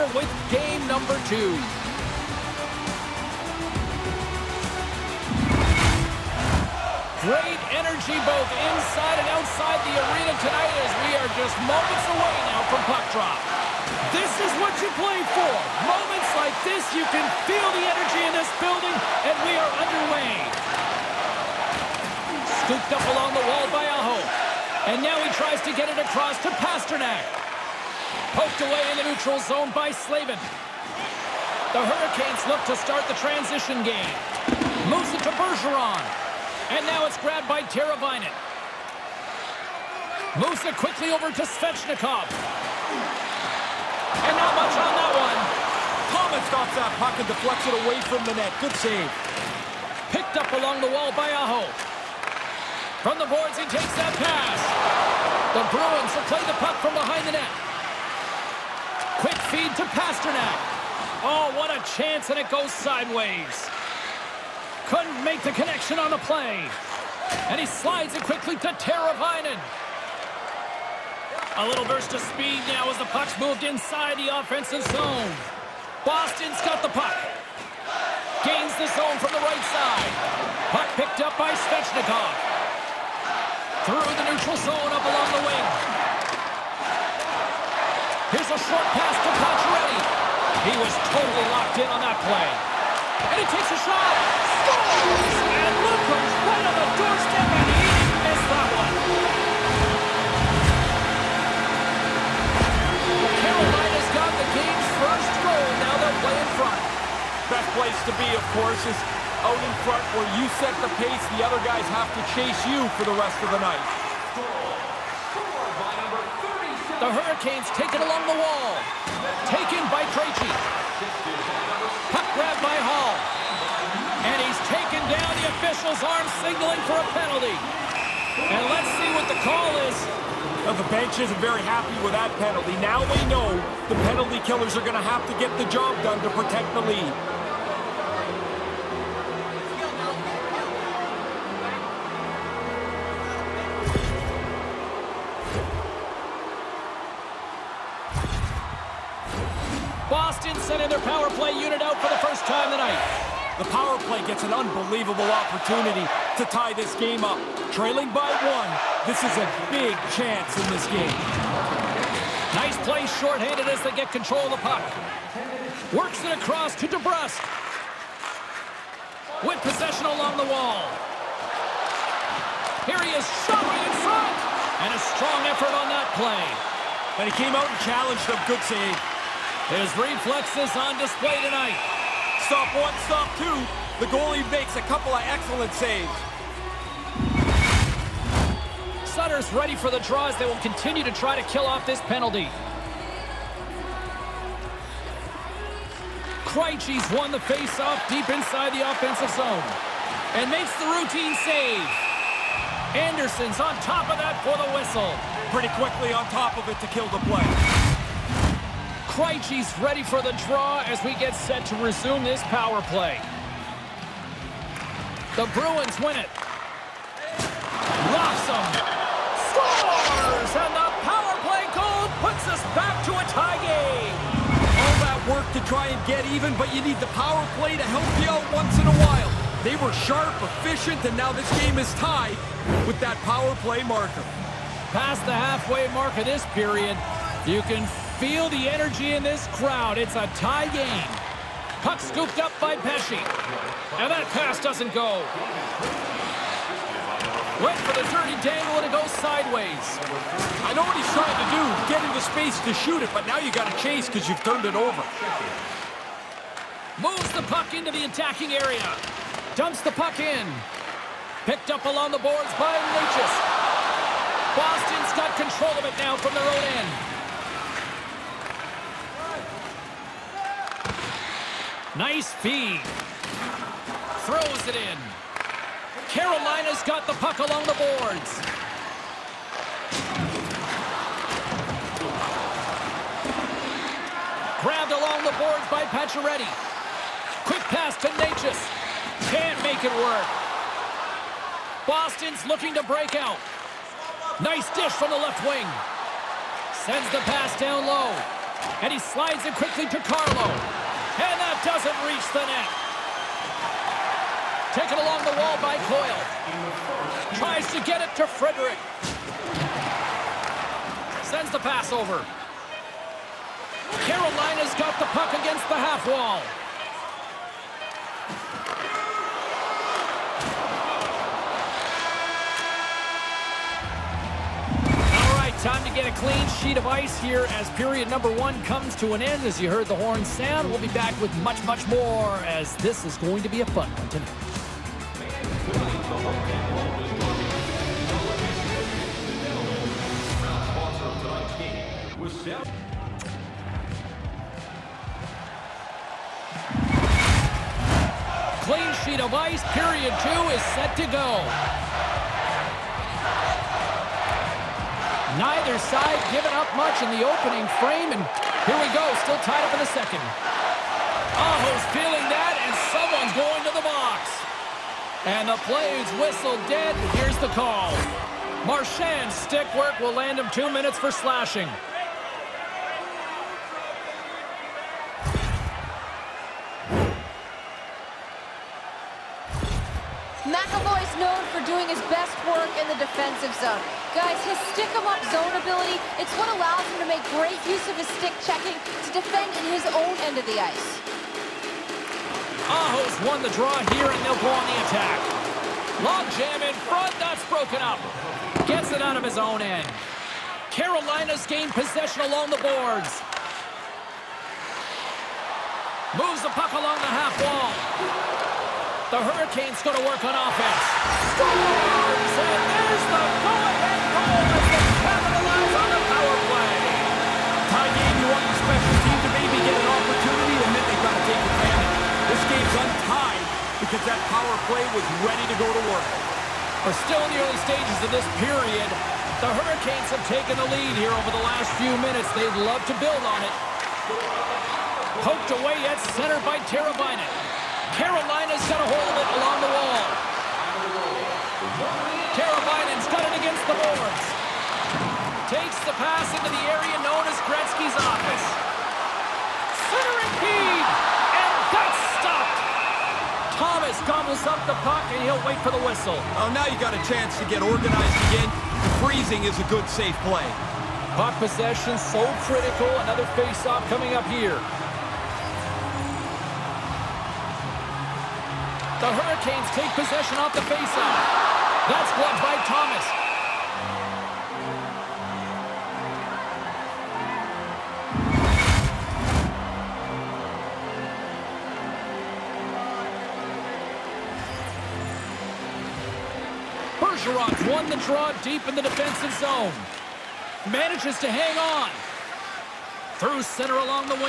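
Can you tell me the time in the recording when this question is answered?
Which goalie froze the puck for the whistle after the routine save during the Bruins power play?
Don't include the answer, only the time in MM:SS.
03:22.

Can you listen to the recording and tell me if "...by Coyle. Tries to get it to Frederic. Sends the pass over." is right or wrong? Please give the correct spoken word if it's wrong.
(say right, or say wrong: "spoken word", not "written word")
right.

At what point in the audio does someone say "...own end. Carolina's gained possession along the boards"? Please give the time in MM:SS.
06:39.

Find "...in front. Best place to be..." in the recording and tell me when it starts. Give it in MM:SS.
01:46.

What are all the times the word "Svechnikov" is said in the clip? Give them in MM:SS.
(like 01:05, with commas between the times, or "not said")
00:41, 01:21.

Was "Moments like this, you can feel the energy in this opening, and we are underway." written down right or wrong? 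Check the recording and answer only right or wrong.
wrong.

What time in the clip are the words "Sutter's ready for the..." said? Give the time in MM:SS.
03:09.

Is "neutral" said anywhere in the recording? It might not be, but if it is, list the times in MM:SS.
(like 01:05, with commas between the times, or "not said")
00:29, 01:24.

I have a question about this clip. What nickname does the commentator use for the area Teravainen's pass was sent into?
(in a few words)
Gretzky's office.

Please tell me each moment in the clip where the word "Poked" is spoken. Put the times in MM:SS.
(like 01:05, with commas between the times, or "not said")
00:28, 07:15.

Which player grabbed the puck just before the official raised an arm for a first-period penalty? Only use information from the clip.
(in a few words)
Hall.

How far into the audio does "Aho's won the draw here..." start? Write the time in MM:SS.
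06:32.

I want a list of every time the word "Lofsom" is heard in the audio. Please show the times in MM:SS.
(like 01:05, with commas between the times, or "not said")
03:37.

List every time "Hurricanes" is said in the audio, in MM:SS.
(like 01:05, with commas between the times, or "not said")
00:31, 01:57, 06:49, 07:09, 07:49.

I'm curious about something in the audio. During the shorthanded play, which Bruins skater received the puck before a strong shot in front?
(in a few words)
DeBrusk.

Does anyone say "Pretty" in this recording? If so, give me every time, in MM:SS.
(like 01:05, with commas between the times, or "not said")
03:25.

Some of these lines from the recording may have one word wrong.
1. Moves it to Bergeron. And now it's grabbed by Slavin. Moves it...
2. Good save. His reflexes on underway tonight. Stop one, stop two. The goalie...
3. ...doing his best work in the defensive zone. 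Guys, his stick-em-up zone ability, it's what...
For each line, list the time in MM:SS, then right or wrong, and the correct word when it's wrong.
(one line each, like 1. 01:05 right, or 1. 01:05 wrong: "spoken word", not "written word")
1. 00:34 wrong: "Teravainen", not "Slavin"
2. 02:58 wrong: "display", not "underway"
3. 06:21 right.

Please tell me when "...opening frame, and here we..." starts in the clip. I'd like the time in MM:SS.
05:57.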